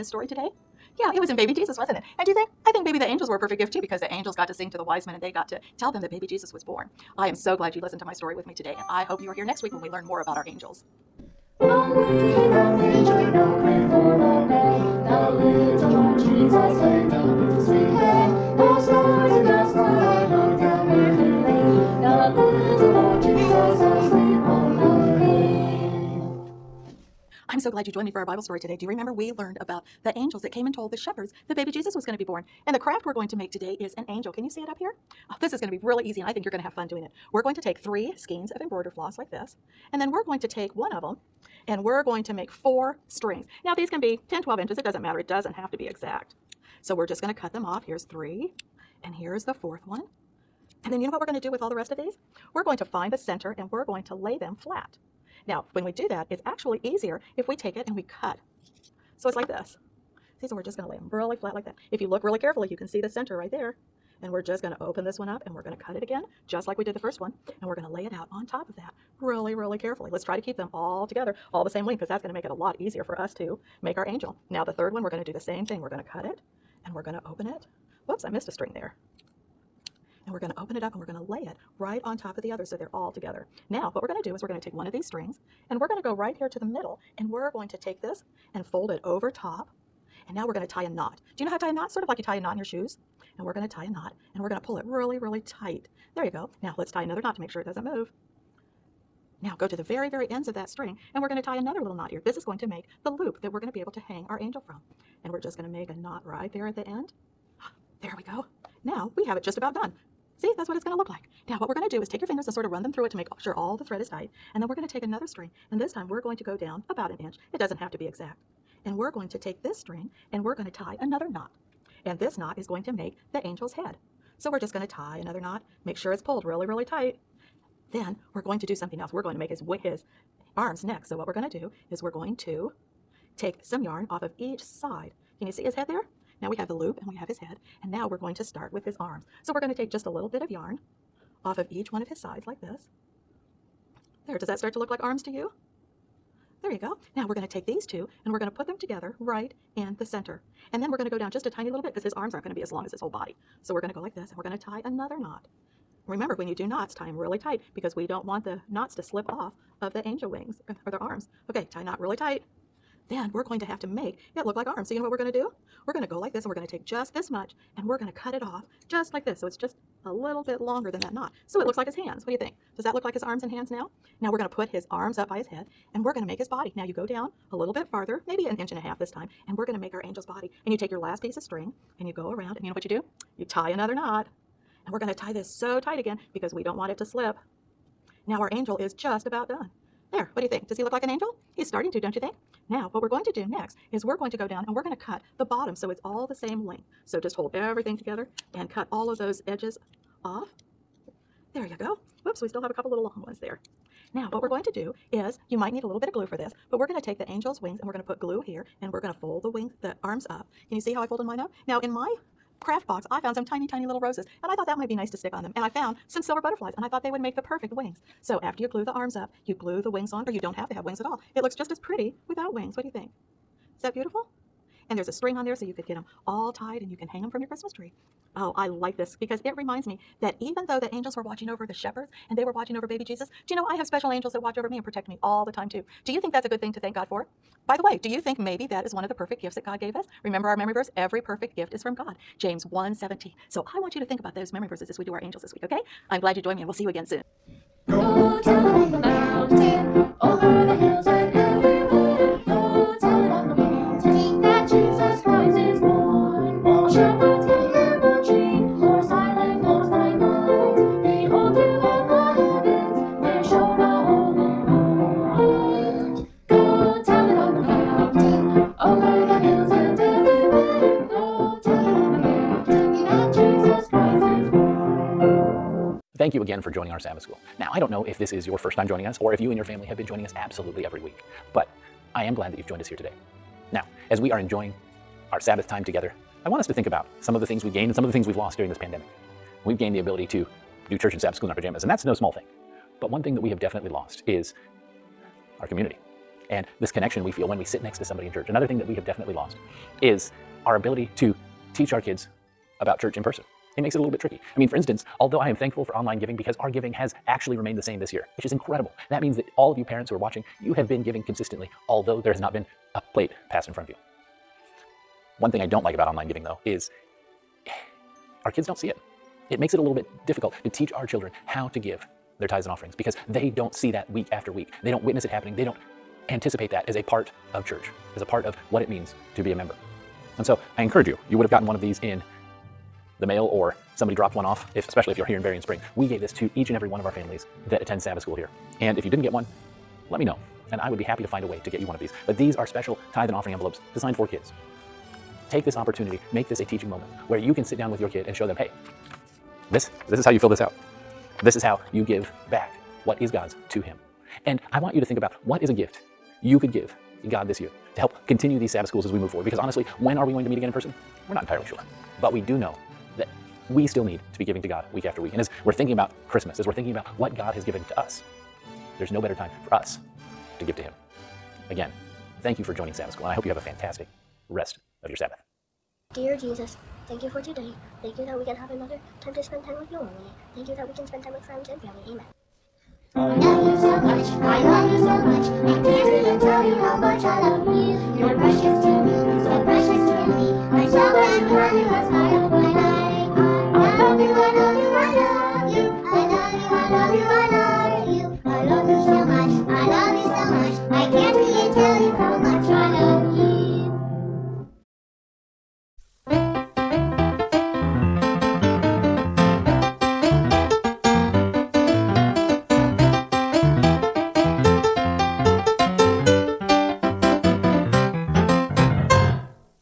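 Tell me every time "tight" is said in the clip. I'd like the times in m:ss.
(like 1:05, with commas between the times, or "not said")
1:35, 1:54, 2:06, 2:37, 2:42, 3:05.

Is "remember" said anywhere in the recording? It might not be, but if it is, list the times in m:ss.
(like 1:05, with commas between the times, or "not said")
0:28, 2:36, 4:00.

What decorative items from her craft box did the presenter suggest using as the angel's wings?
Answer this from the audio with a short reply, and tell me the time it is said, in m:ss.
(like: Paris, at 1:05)
silver butterflies, at 3:36.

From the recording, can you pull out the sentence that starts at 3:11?
He's starting to, don't you think?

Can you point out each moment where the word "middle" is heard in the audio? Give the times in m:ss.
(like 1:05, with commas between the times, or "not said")
1:26.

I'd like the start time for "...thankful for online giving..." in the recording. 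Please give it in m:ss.
5:05.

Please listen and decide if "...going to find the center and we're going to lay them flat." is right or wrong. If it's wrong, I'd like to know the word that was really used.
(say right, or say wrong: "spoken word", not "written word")
right.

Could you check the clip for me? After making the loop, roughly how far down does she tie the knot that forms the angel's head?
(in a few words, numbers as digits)
about an inch.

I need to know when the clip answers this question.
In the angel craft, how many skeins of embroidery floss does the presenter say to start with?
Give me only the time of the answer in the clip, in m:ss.
0:37.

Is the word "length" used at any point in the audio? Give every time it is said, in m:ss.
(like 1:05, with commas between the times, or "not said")
1:11, 3:16.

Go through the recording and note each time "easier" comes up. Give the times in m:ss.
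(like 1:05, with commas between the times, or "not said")
0:56, 1:12.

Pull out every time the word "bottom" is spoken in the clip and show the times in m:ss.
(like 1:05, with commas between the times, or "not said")
3:15.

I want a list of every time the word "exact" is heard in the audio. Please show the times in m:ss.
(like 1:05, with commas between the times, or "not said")
0:45, 1:58.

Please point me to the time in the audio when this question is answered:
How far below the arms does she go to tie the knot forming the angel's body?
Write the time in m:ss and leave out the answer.
2:58.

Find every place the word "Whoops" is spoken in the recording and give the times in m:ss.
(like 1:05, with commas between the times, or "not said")
1:18, 3:22.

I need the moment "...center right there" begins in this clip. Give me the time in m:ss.
1:03.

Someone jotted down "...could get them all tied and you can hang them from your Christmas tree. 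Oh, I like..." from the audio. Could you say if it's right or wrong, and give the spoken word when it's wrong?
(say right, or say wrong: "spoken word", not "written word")
right.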